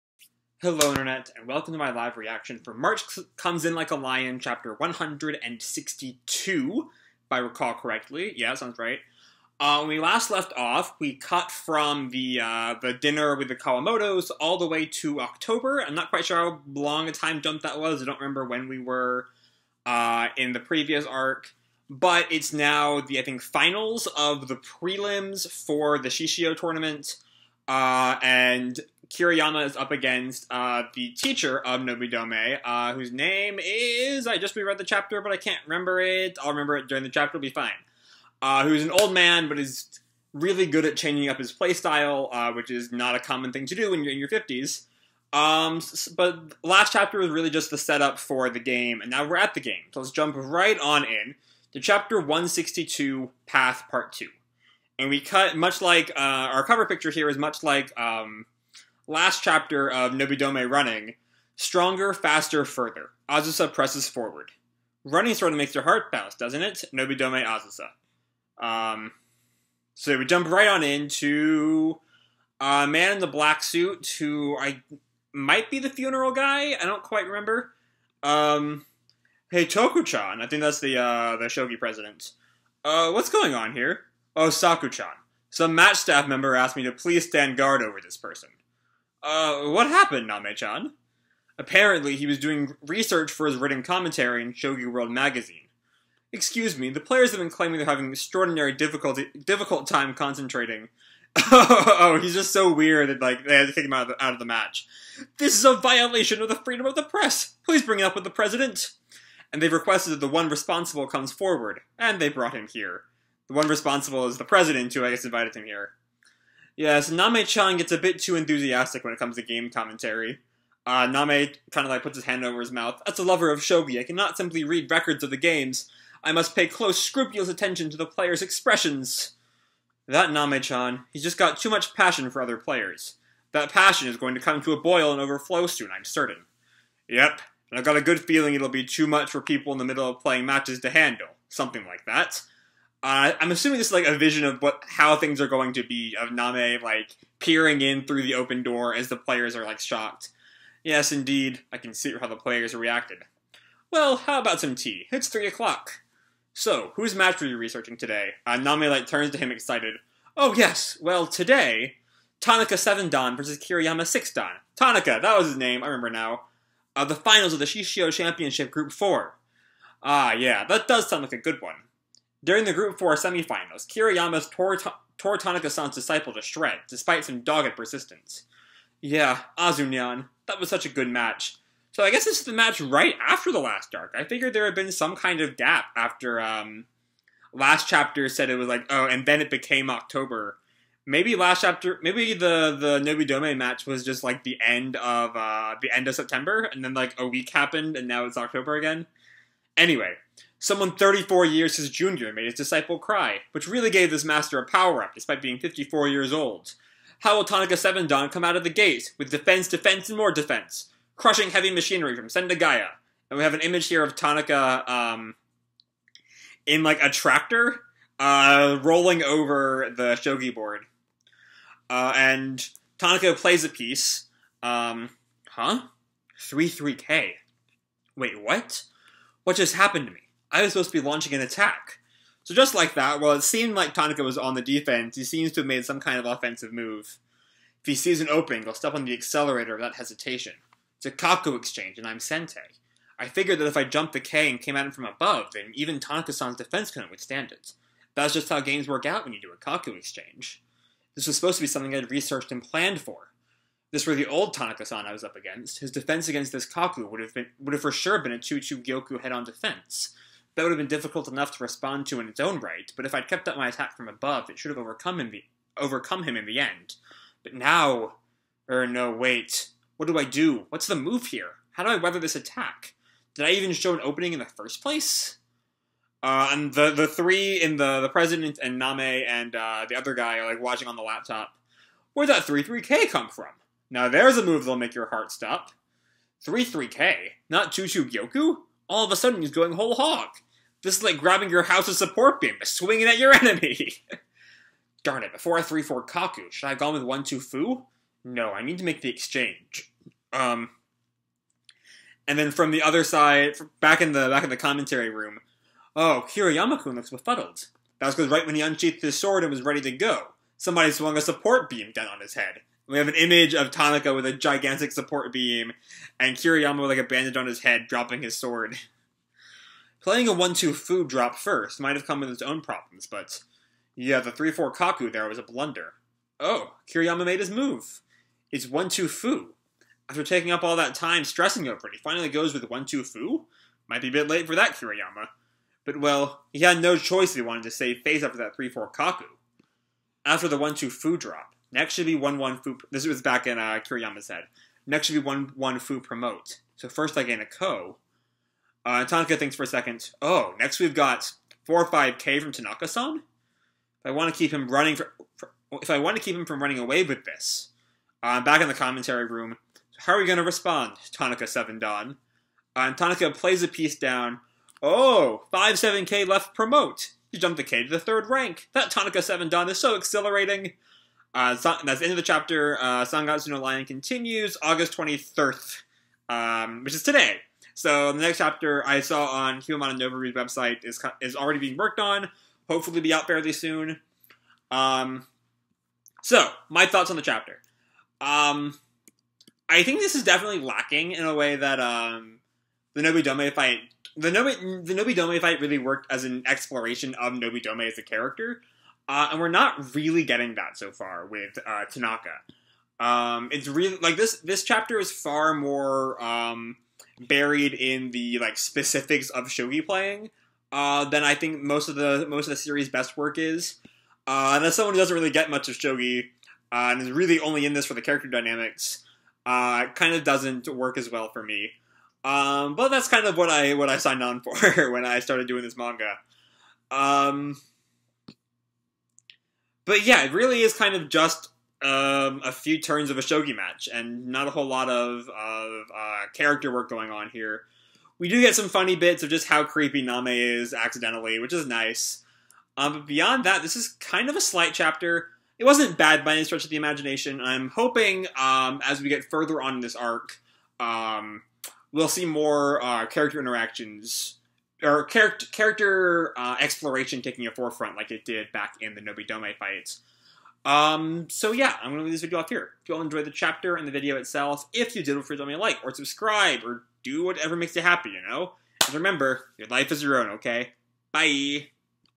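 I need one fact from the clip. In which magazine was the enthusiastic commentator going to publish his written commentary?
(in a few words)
Shogi World.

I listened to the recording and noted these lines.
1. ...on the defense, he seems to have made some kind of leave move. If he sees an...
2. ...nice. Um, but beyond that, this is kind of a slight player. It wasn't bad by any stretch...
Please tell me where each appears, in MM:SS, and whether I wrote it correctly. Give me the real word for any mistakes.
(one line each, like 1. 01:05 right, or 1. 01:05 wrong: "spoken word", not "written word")
1. 03:54 wrong: "offensive", not "leave"
2. 07:21 wrong: "chapter", not "player".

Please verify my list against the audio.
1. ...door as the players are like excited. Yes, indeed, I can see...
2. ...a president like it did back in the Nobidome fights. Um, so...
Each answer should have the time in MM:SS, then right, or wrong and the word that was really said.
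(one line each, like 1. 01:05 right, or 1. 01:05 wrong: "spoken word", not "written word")
1. 02:28 wrong: "shocked", not "excited"
2. 07:37 wrong: "forefront", not "president".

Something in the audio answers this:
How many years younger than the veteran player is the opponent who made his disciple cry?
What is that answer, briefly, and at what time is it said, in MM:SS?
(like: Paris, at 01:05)
34, at 03:20.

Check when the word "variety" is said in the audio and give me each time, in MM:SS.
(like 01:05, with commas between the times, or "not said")
not said.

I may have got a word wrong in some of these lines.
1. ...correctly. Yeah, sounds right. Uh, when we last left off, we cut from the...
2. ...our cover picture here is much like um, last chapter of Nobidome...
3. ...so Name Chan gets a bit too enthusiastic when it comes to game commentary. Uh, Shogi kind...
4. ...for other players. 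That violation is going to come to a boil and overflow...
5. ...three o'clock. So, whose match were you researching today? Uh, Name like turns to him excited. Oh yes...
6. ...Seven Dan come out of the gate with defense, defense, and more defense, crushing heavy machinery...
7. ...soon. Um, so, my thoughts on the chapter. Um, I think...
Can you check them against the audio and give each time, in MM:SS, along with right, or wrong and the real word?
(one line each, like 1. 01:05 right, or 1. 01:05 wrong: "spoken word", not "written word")
1. 00:07 right
2. 00:56 right
3. 01:57 wrong: "Name", not "Shogi"
4. 02:12 wrong: "passion", not "violation"
5. 02:35 right
6. 03:27 right
7. 06:23 right.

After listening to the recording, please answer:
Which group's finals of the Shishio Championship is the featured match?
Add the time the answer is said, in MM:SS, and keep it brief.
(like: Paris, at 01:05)
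Group Four, at 02:48.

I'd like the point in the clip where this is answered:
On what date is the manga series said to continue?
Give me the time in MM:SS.
06:14.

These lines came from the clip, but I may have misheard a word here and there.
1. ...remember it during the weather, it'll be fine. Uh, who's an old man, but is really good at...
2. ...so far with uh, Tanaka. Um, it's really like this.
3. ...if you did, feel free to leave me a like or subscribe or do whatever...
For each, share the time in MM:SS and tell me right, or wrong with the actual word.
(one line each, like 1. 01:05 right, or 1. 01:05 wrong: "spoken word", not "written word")
1. 00:36 wrong: "chapter", not "weather"
2. 06:40 right
3. 07:44 right.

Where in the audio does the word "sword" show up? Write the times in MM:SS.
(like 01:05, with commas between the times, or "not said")
05:09, 05:18.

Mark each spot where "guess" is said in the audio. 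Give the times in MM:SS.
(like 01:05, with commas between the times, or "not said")
01:55, 03:02.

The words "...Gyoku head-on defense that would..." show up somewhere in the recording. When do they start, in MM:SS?
04:18.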